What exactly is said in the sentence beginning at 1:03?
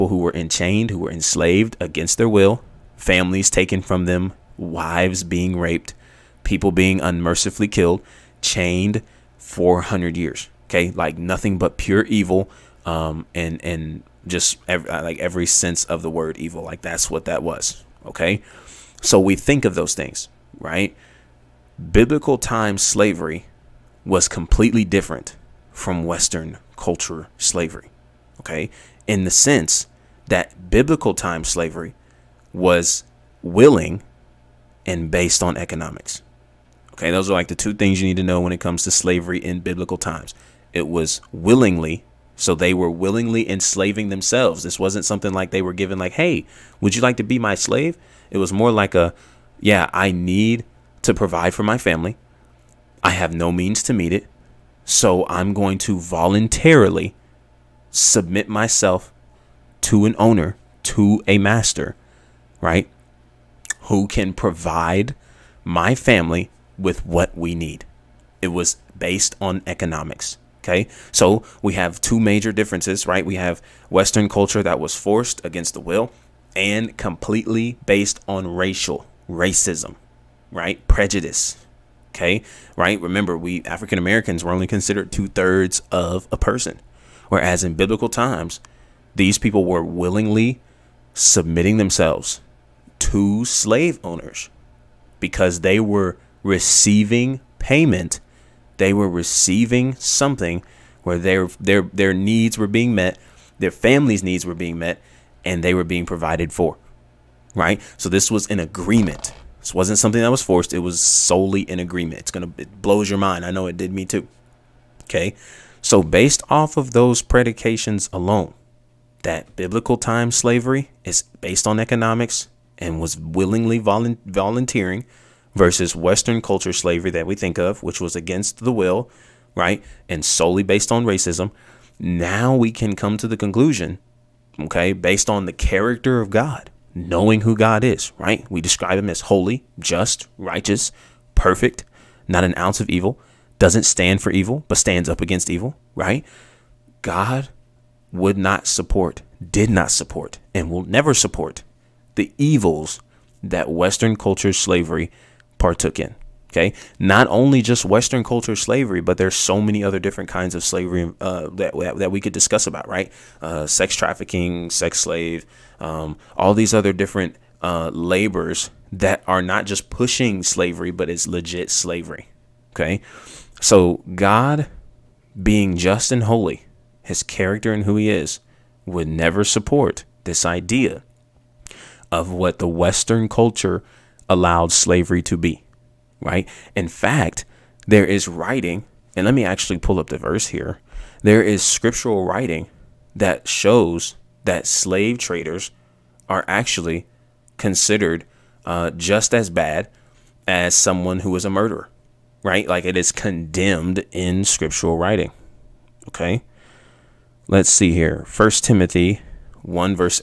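Who can provide my family with what we need." It was based on economics.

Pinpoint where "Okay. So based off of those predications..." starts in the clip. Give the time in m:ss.
1:55.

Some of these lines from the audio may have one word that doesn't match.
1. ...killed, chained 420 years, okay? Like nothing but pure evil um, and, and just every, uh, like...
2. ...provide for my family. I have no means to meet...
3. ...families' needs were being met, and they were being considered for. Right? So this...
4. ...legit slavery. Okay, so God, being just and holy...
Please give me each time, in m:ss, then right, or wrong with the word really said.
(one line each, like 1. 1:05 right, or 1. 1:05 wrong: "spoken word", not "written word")
1. 0:07 wrong: "400", not "420"
2. 0:51 right
3. 1:43 wrong: "provided", not "considered"
4. 2:51 right.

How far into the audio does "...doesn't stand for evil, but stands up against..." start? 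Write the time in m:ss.
2:23.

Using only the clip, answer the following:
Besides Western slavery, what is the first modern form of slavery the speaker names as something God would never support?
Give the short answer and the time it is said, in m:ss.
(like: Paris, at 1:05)
Sex trafficking, at 2:43.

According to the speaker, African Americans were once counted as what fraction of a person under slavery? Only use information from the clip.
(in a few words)
Two thirds.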